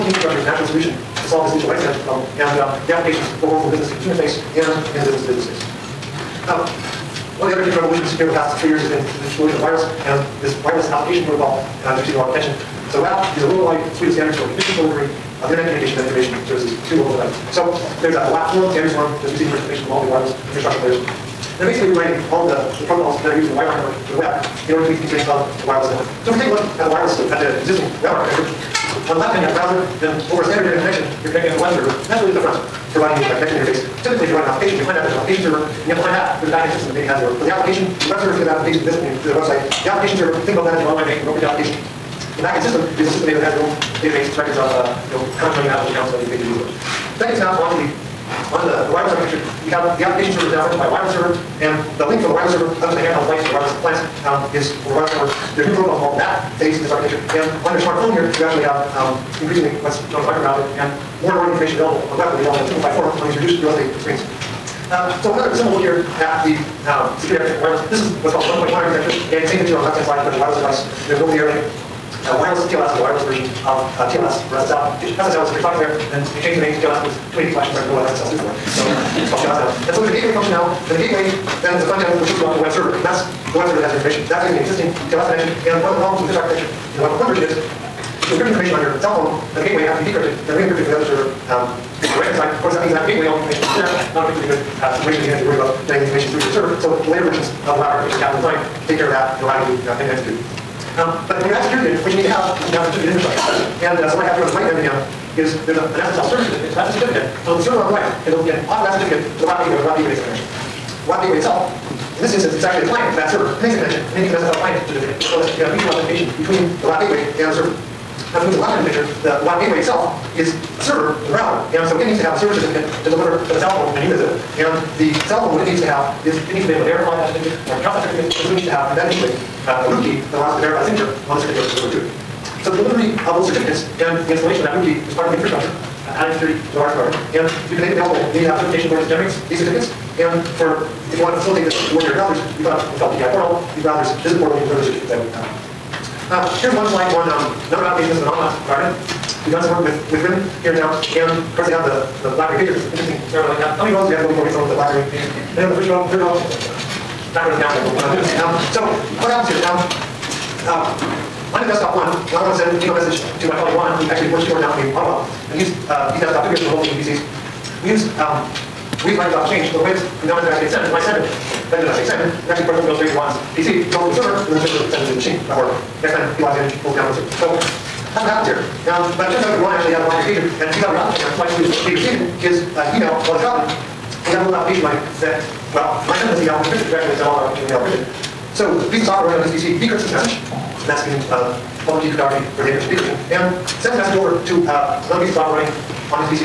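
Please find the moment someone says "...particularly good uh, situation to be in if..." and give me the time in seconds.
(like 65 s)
94 s.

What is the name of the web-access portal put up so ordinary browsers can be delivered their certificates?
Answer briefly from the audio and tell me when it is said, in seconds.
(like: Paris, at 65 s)
PKI portal, at 143 s.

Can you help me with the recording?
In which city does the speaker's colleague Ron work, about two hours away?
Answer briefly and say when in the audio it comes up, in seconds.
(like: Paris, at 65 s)
Ottawa, at 164 s.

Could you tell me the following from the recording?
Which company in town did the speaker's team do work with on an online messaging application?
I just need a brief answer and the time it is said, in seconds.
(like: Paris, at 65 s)
RIM, at 150 s.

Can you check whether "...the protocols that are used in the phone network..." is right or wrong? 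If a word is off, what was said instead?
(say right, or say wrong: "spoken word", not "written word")
wrong: "wireline", not "phone".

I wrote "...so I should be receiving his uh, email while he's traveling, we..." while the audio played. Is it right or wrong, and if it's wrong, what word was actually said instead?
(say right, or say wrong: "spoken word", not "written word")
right.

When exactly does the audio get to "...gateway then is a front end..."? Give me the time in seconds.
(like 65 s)
80 s.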